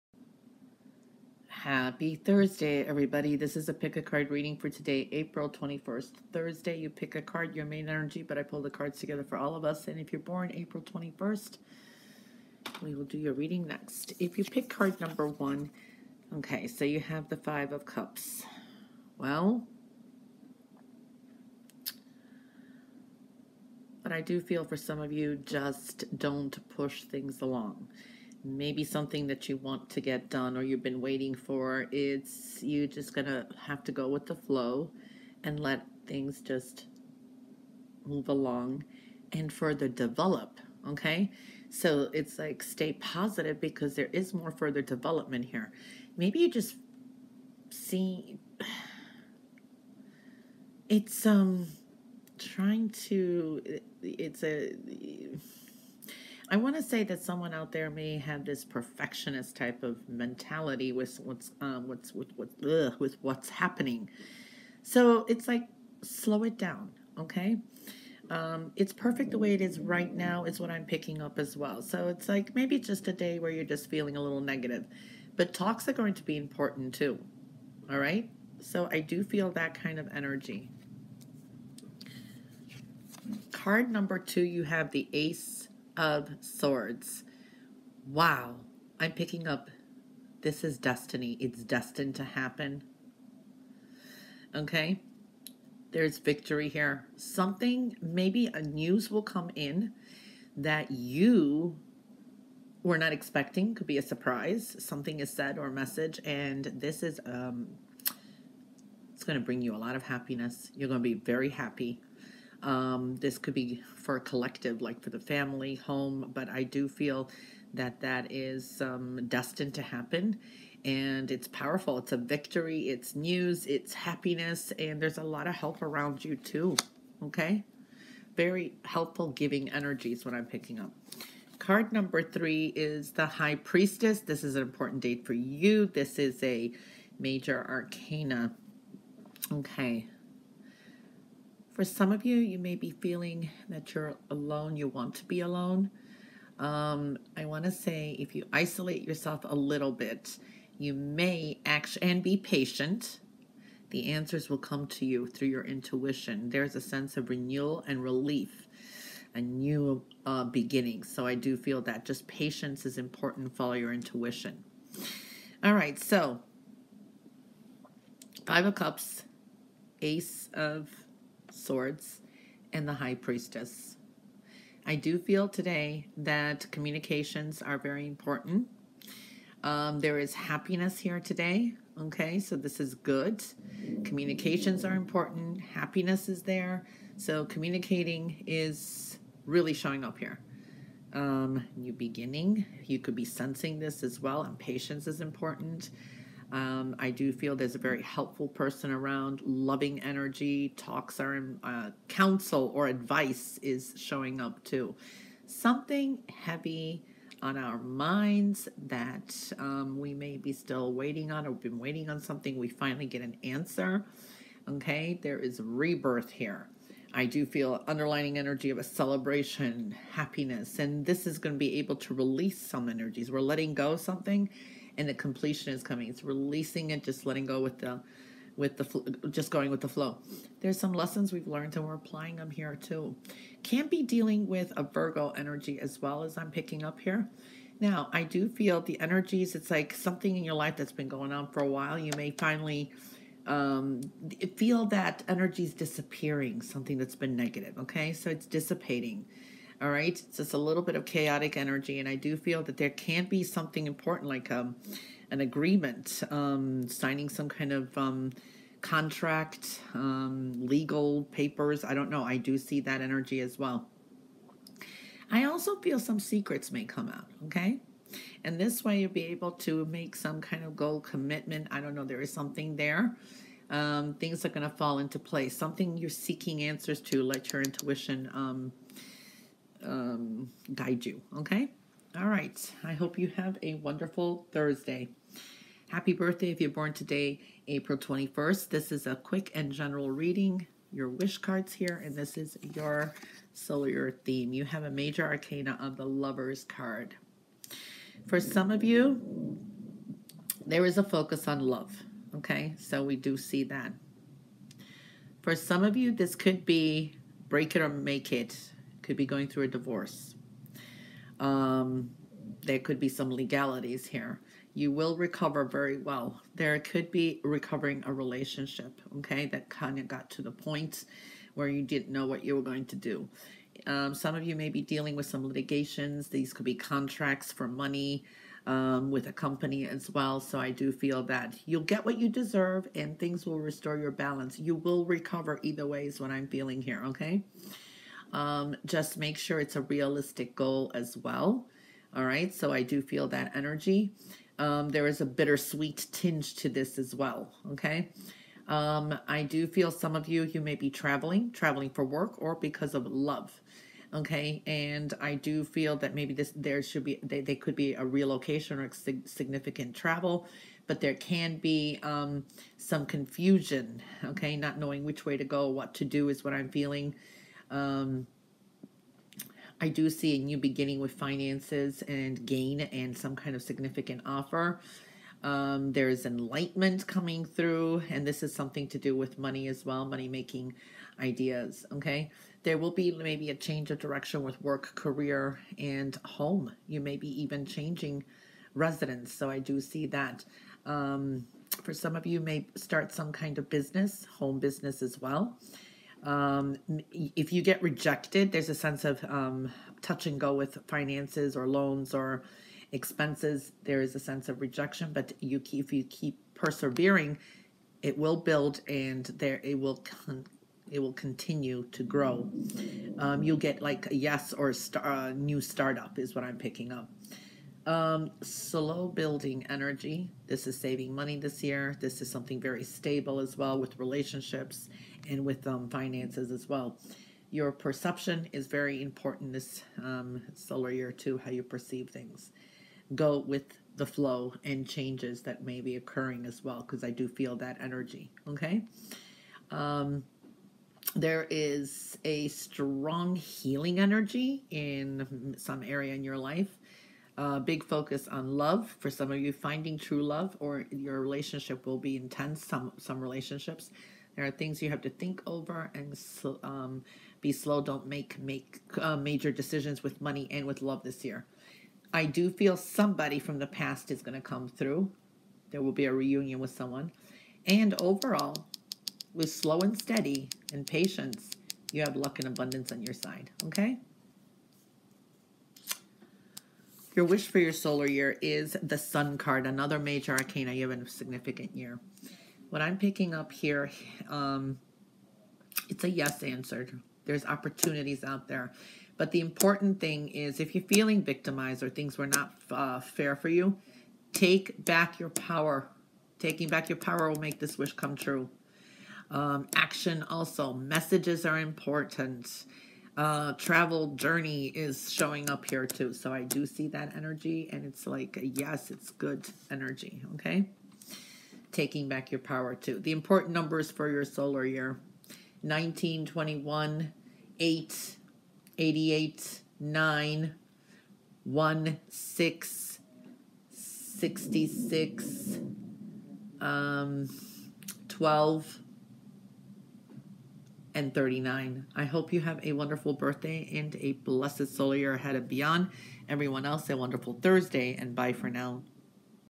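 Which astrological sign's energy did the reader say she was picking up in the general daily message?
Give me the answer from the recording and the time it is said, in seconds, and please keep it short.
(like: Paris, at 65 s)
Virgo, at 234 s.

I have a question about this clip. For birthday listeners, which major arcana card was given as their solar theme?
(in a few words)
The Lovers.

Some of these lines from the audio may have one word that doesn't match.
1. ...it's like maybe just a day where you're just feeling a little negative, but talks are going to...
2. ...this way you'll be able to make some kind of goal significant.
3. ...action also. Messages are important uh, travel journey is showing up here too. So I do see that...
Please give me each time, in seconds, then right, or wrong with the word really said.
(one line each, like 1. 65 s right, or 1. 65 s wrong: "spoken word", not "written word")
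1. 72 s right
2. 268 s wrong: "commitment", not "significant"
3. 499 s right.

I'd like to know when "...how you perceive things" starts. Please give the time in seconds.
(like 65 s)
431 s.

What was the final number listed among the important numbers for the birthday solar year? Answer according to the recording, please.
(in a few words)
39.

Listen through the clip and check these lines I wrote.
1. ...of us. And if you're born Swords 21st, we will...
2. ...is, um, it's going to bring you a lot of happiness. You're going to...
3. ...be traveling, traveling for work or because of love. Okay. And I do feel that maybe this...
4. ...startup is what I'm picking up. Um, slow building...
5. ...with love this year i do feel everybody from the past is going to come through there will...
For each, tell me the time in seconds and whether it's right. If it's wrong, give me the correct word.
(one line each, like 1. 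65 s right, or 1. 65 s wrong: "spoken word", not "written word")
1. 9 s wrong: "April", not "Swords"
2. 107 s right
3. 350 s right
4. 415 s right
5. 460 s wrong: "somebody", not "everybody".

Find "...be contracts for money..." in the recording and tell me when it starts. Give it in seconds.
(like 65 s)
326 s.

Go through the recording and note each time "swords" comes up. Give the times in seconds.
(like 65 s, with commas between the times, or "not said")
86 s, 171 s.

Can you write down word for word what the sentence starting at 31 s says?
It's you just gonna have to go with the flow and let things just move along and further develop.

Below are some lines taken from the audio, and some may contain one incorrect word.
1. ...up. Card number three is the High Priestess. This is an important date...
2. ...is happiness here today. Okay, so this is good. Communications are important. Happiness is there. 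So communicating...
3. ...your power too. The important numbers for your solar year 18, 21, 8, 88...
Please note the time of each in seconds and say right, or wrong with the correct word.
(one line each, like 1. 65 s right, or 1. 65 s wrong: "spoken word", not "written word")
1. 130 s right
2. 180 s right
3. 512 s wrong: "19", not "18".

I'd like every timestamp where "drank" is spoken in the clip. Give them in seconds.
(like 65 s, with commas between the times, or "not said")
not said.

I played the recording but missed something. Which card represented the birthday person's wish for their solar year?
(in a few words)
The Sun.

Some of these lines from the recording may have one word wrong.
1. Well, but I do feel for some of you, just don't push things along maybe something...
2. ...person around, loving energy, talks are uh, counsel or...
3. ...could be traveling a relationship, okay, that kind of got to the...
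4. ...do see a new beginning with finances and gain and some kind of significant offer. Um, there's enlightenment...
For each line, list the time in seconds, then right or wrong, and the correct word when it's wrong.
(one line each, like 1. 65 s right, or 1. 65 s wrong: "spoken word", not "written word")
1. 19 s right
2. 198 s right
3. 316 s wrong: "recovering", not "traveling"
4. 369 s right.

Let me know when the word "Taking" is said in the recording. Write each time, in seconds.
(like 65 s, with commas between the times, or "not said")
496 s, 511 s.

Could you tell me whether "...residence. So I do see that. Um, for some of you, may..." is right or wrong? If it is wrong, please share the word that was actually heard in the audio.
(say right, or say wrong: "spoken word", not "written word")
right.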